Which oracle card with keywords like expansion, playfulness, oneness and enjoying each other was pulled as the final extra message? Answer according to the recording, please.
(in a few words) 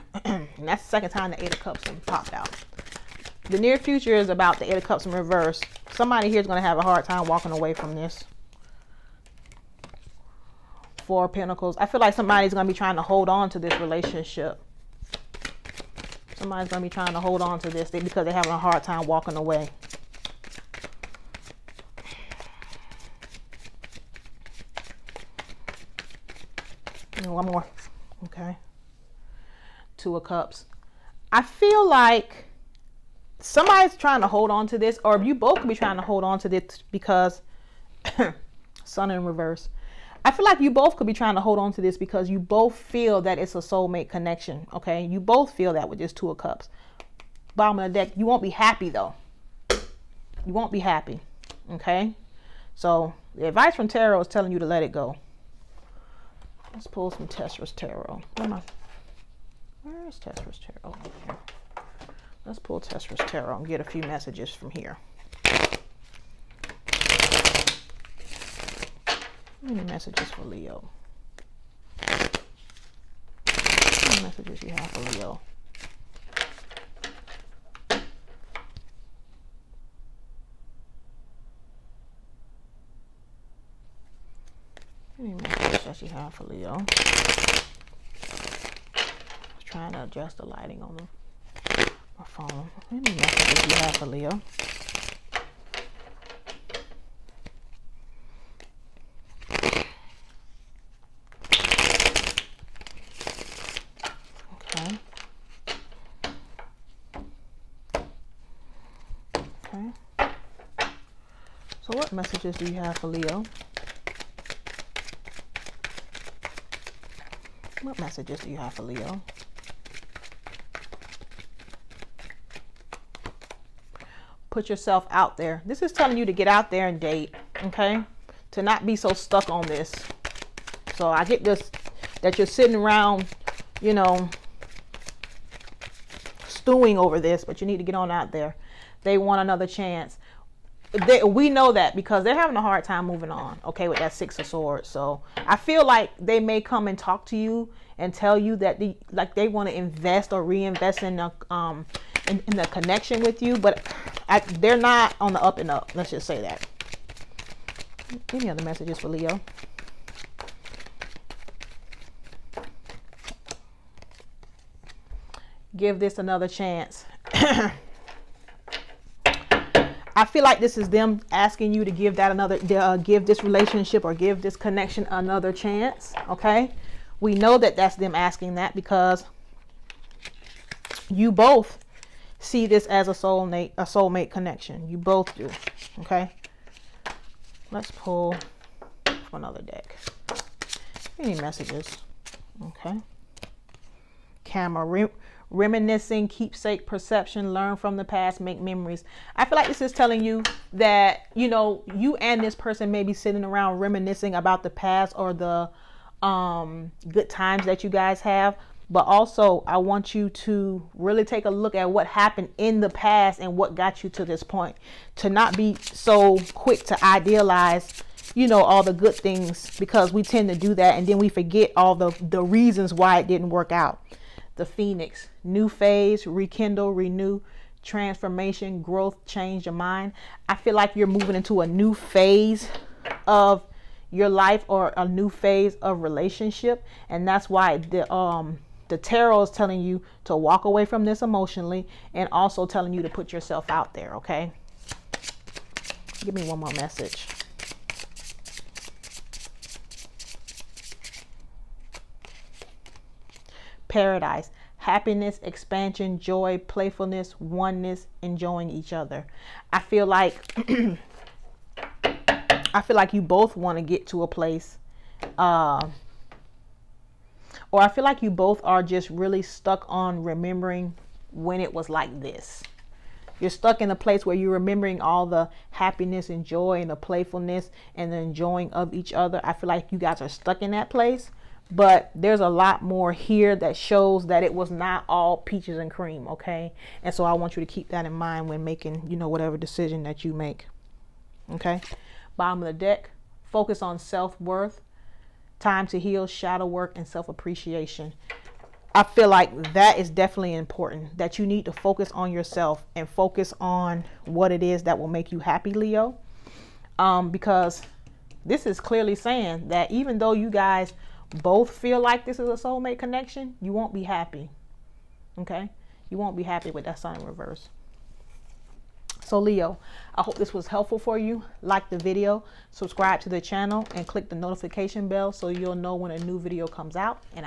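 Paradise.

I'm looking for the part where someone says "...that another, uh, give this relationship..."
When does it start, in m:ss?
2:52.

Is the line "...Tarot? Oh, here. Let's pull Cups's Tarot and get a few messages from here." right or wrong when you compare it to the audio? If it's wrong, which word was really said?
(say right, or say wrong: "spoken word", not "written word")
wrong: "Tessera", not "Cups".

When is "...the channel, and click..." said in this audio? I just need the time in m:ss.
5:23.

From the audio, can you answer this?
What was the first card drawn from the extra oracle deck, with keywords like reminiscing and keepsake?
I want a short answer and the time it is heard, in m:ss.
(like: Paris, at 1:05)
Camera, at 3:14.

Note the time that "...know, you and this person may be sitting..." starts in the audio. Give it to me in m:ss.
3:21.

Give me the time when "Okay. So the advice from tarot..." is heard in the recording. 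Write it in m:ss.
0:51.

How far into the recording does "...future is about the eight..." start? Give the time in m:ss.
0:03.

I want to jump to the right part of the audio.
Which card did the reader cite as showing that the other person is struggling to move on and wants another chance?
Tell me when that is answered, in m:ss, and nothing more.
2:24.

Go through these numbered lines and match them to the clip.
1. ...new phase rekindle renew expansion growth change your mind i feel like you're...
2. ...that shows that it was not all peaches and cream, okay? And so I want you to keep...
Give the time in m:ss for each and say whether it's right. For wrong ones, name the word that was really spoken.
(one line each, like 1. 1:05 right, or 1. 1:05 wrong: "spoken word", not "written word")
1. 3:45 wrong: "transformation", not "expansion"
2. 4:43 right.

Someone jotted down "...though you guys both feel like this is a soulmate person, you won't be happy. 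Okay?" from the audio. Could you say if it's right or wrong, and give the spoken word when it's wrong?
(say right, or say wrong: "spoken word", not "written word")
wrong: "connection", not "person".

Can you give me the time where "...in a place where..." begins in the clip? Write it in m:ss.
4:33.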